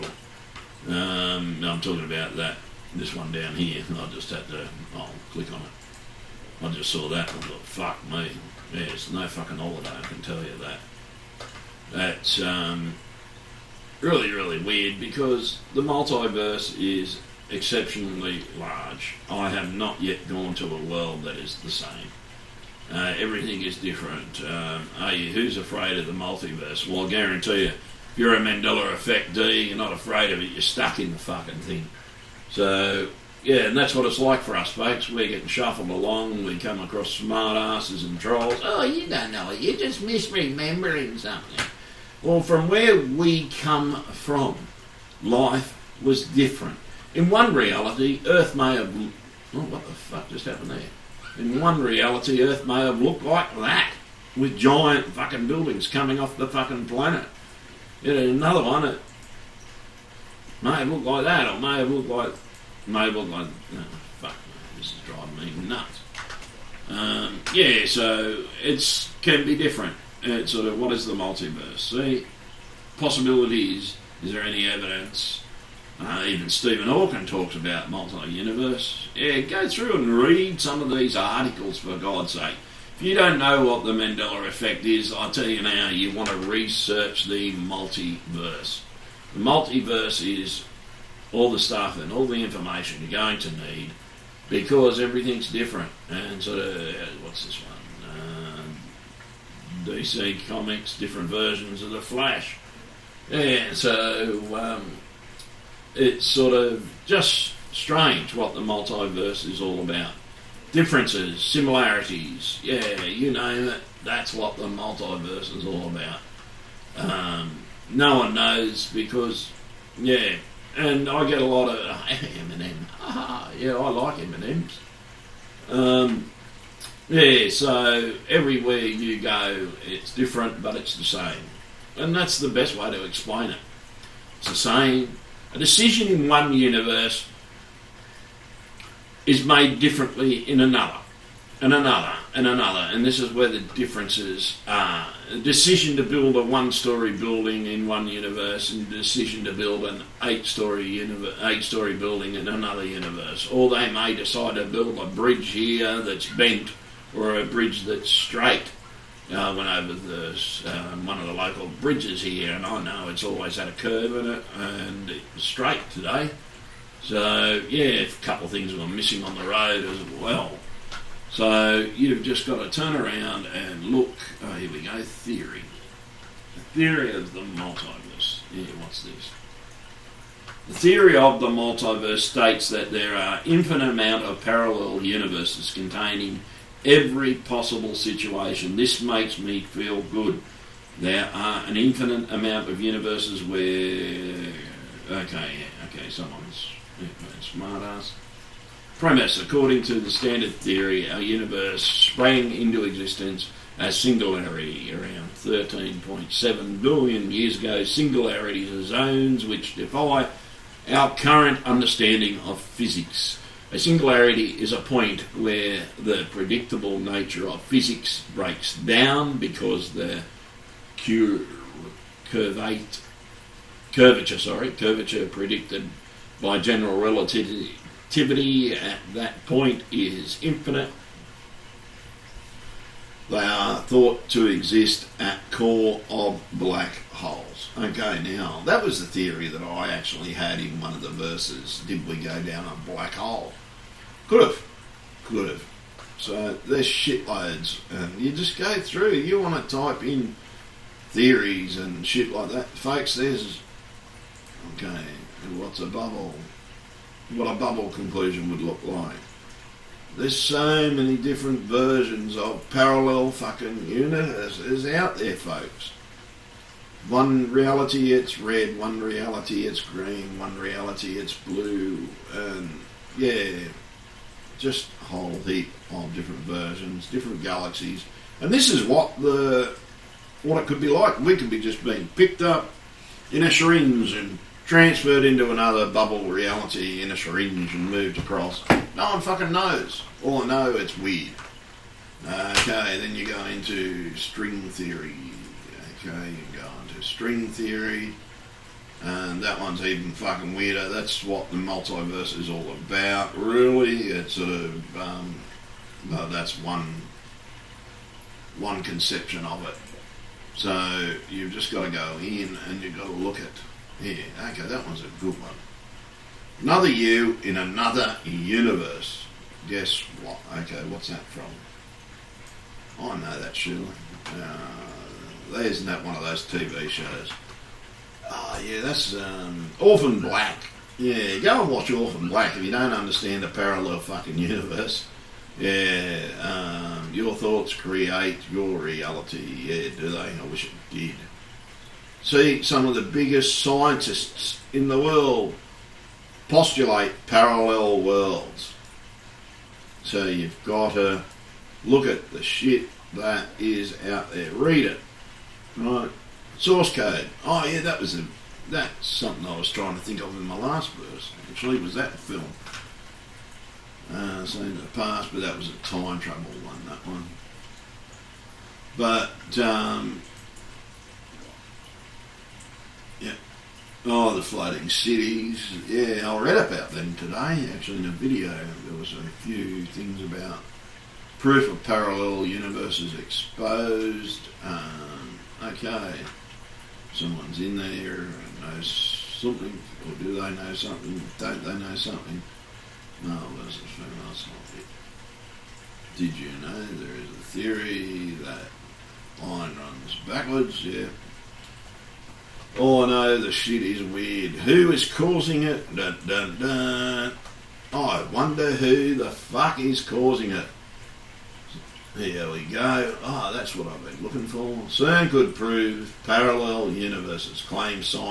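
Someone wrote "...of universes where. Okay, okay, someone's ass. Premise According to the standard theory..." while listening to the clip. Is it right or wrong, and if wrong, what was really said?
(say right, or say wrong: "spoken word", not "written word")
right.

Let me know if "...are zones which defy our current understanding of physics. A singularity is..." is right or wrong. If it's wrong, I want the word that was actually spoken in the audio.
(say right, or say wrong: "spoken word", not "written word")
right.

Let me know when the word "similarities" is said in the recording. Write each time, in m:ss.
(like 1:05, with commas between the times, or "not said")
1:51.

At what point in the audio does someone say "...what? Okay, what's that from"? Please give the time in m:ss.
5:20.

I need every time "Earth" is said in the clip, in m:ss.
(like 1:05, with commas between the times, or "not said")
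0:48, 0:52.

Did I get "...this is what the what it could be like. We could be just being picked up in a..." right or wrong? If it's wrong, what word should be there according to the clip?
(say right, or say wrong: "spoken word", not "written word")
right.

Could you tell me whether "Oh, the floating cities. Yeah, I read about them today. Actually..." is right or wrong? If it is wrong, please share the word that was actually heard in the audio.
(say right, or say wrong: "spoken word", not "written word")
right.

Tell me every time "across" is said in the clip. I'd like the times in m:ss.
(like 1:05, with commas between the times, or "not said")
0:36, 4:48.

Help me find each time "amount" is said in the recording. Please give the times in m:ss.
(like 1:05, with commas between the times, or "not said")
3:03, 3:12.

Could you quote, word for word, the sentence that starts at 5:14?
Okay, that one's a good one.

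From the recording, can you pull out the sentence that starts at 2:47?
So yeah, a couple of things were missing on the road as well.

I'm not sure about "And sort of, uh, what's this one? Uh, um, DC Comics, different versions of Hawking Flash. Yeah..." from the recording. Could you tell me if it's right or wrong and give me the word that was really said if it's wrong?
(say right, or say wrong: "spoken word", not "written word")
wrong: "The", not "Hawking".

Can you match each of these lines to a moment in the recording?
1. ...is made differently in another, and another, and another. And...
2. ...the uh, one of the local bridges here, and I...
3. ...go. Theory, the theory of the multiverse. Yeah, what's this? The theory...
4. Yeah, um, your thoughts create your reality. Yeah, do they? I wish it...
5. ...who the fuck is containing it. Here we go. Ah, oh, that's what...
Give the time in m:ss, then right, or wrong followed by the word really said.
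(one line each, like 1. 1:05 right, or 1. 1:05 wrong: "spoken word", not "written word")
1. 2:19 right
2. 2:39 right
3. 2:54 right
4. 5:35 right
5. 6:48 wrong: "causing", not "containing".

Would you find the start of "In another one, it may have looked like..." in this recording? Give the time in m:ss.
0:58.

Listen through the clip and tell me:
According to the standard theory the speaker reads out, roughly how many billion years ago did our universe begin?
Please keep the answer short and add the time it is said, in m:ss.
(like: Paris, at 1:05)
13.7 billion, at 3:25.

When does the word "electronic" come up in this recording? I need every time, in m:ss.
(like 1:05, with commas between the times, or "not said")
not said.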